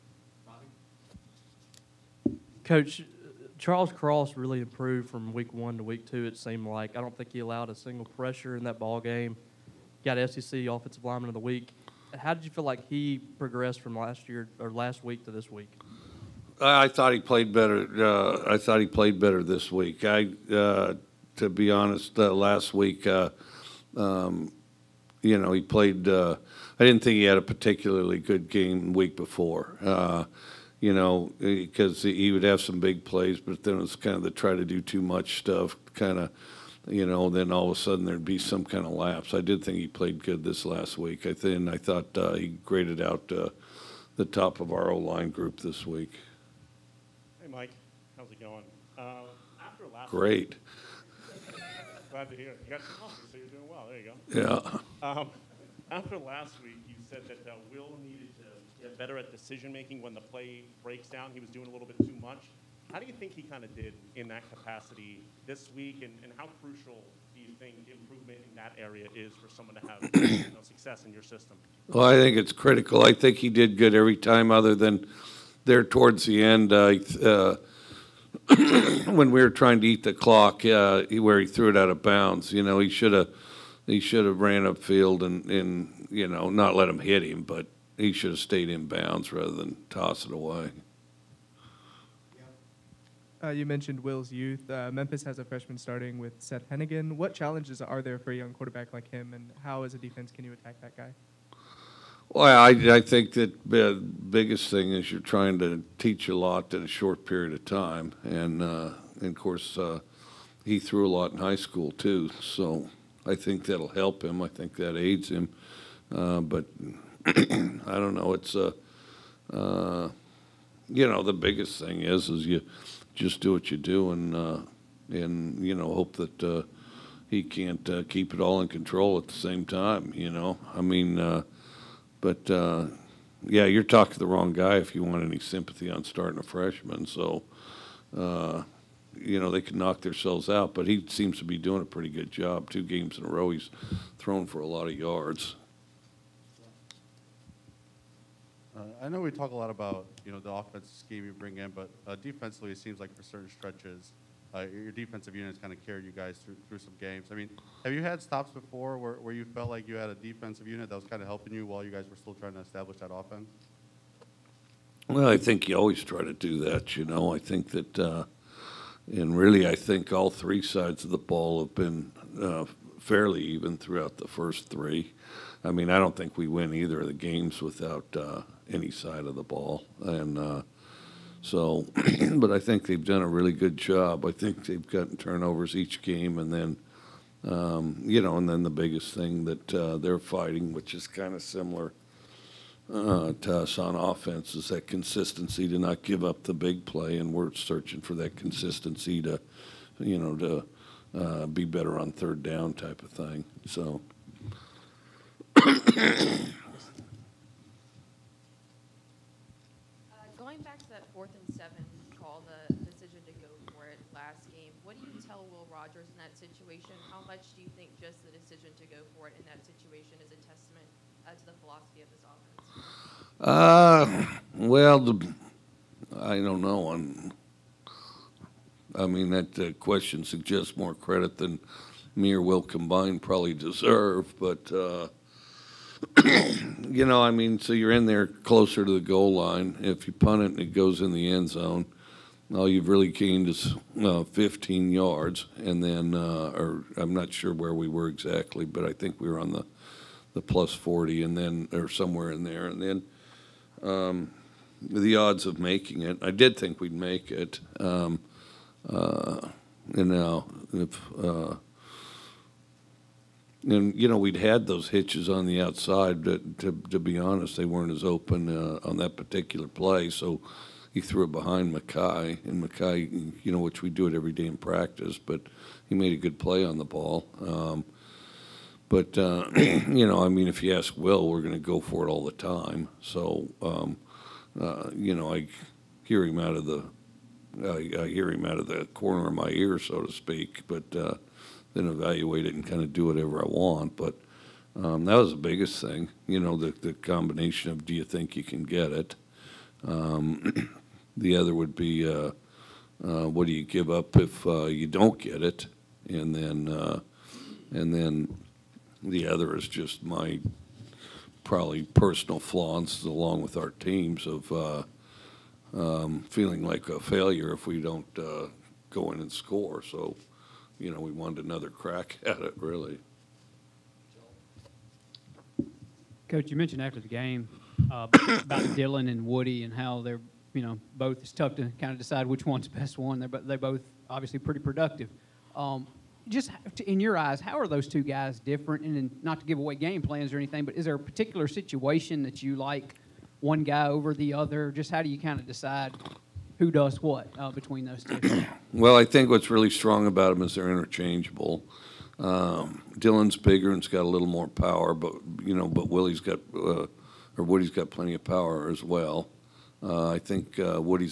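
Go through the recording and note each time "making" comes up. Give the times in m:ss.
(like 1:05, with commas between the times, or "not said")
0:59, 4:15.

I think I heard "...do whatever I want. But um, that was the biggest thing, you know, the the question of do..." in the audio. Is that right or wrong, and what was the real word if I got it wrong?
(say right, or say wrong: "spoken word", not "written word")
wrong: "combination", not "question".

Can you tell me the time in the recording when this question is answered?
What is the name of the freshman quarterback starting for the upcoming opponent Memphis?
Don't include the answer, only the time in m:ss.
1:36.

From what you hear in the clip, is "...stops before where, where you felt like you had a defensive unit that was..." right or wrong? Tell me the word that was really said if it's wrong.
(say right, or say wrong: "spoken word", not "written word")
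right.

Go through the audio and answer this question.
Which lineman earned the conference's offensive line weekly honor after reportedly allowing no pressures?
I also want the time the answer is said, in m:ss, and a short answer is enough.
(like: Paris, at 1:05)
Charles Cross, at 0:03.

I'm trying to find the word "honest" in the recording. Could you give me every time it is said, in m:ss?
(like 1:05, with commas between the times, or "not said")
0:21, 4:27.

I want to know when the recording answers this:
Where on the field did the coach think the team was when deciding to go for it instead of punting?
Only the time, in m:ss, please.
4:10.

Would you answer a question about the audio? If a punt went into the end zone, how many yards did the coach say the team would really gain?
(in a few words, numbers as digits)
15.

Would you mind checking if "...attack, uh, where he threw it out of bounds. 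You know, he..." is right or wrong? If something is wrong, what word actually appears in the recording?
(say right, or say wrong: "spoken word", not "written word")
wrong: "clock", not "attack".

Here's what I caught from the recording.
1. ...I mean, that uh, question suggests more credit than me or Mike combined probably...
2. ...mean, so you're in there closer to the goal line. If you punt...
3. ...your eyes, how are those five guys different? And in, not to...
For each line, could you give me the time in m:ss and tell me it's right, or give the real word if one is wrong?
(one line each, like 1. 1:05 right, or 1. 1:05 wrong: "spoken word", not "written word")
1. 3:48 wrong: "Will", not "Mike"
2. 3:57 right
3. 5:36 wrong: "two", not "five".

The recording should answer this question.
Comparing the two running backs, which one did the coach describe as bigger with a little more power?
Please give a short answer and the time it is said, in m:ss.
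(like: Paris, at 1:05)
Dylan, at 5:52.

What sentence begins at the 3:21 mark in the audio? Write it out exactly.
Uh, be better on third down type of thing.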